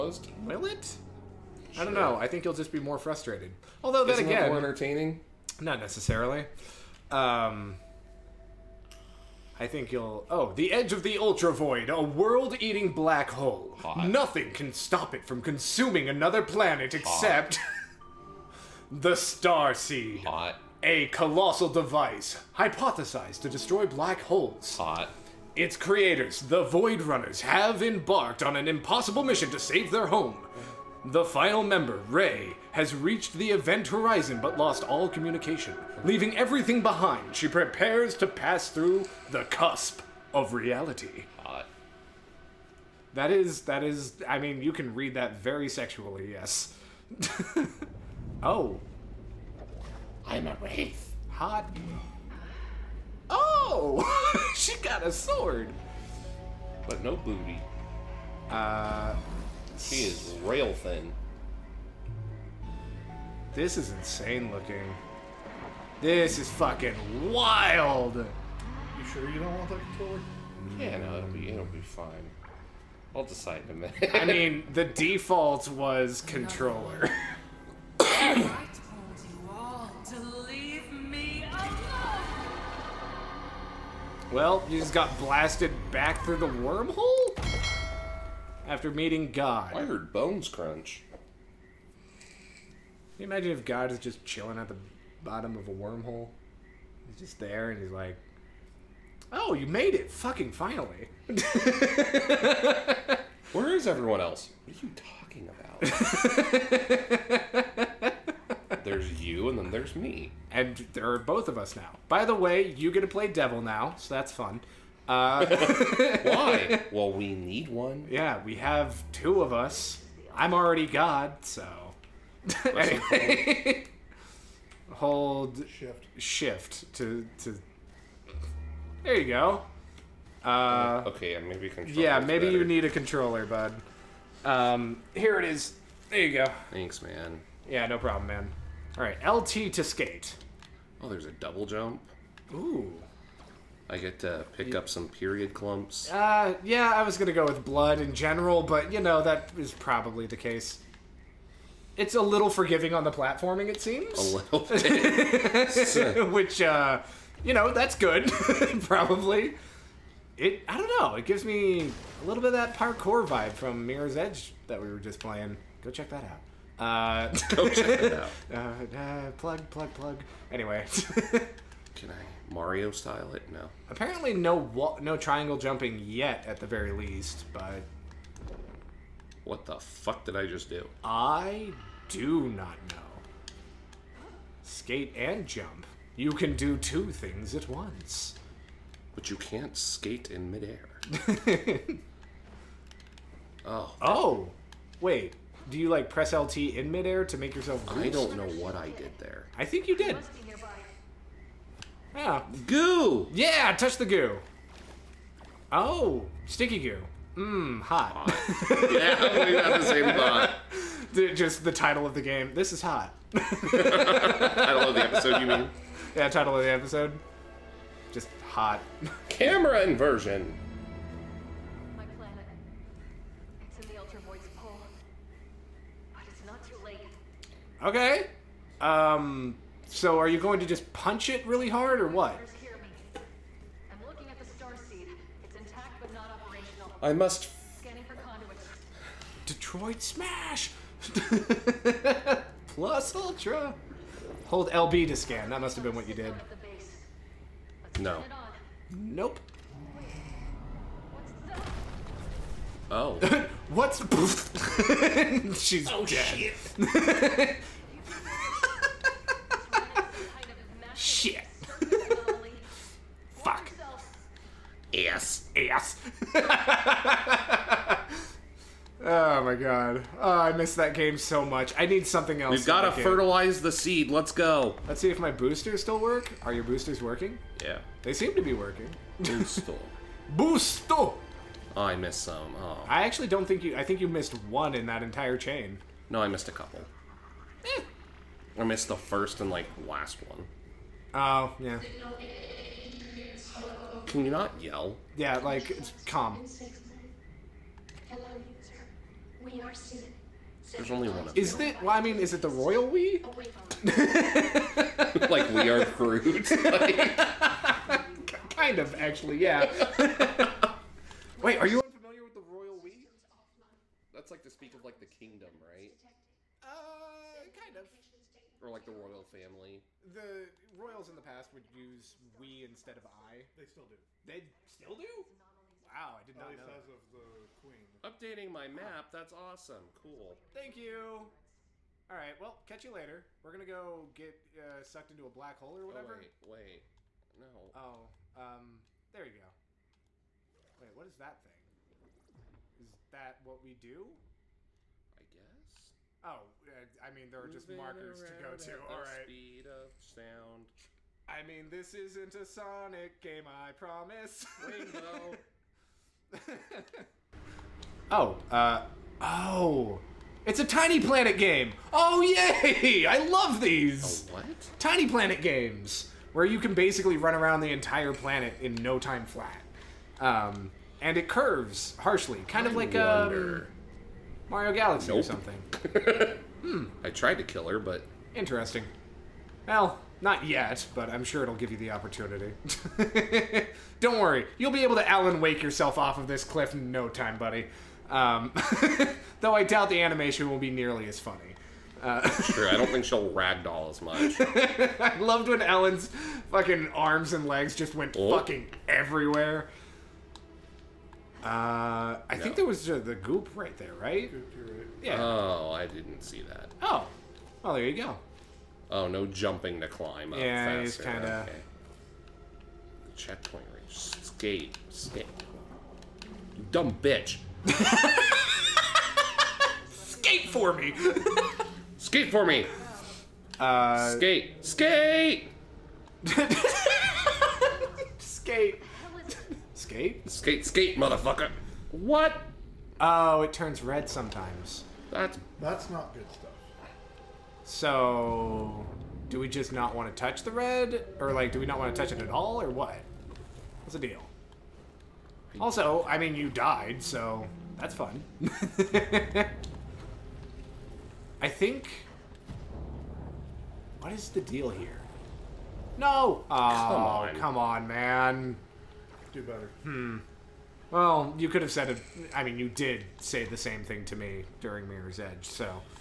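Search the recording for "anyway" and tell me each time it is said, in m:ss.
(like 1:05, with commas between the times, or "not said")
2:02, 2:50.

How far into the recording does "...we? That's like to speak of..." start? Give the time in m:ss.
5:12.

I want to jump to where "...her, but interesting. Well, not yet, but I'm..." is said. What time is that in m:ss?
6:17.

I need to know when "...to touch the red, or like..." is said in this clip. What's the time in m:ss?
7:20.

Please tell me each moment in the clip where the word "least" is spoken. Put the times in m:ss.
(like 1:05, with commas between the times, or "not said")
2:56, 5:26.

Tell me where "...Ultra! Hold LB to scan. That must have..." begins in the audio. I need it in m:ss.
4:03.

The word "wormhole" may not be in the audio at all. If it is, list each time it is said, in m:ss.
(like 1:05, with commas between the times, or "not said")
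1:26, 1:35.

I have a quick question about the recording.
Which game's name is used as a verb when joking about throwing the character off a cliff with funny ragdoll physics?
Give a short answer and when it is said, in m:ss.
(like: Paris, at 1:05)
Alan Wake, at 6:25.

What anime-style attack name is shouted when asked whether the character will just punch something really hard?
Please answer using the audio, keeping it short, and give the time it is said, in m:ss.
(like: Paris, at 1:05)
Detroit Smash, at 3:59.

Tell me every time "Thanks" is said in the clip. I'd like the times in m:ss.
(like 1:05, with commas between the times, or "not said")
2:16, 5:30.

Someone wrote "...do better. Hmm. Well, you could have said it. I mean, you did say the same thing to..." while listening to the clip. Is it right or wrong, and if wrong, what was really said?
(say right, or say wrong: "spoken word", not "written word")
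right.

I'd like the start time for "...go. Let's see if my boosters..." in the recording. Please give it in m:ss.
4:34.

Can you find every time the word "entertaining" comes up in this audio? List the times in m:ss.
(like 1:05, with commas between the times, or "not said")
0:04.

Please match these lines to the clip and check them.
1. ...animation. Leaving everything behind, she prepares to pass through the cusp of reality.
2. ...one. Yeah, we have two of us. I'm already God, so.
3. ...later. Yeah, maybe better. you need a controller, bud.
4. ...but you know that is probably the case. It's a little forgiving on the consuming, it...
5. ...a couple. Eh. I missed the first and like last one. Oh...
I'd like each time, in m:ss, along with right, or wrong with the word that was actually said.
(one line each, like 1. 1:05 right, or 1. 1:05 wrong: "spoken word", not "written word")
1. 0:35 wrong: "communication", not "animation"
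2. 1:57 right
3. 2:11 wrong: "controller", not "later"
4. 2:28 wrong: "platforming", not "consuming"
5. 4:46 right.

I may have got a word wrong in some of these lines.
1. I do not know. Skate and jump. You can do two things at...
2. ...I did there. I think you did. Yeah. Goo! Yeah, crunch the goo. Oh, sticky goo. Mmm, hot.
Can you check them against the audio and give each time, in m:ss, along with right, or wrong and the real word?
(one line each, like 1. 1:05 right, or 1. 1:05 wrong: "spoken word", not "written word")
1. 3:01 right
2. 3:18 wrong: "touch", not "crunch".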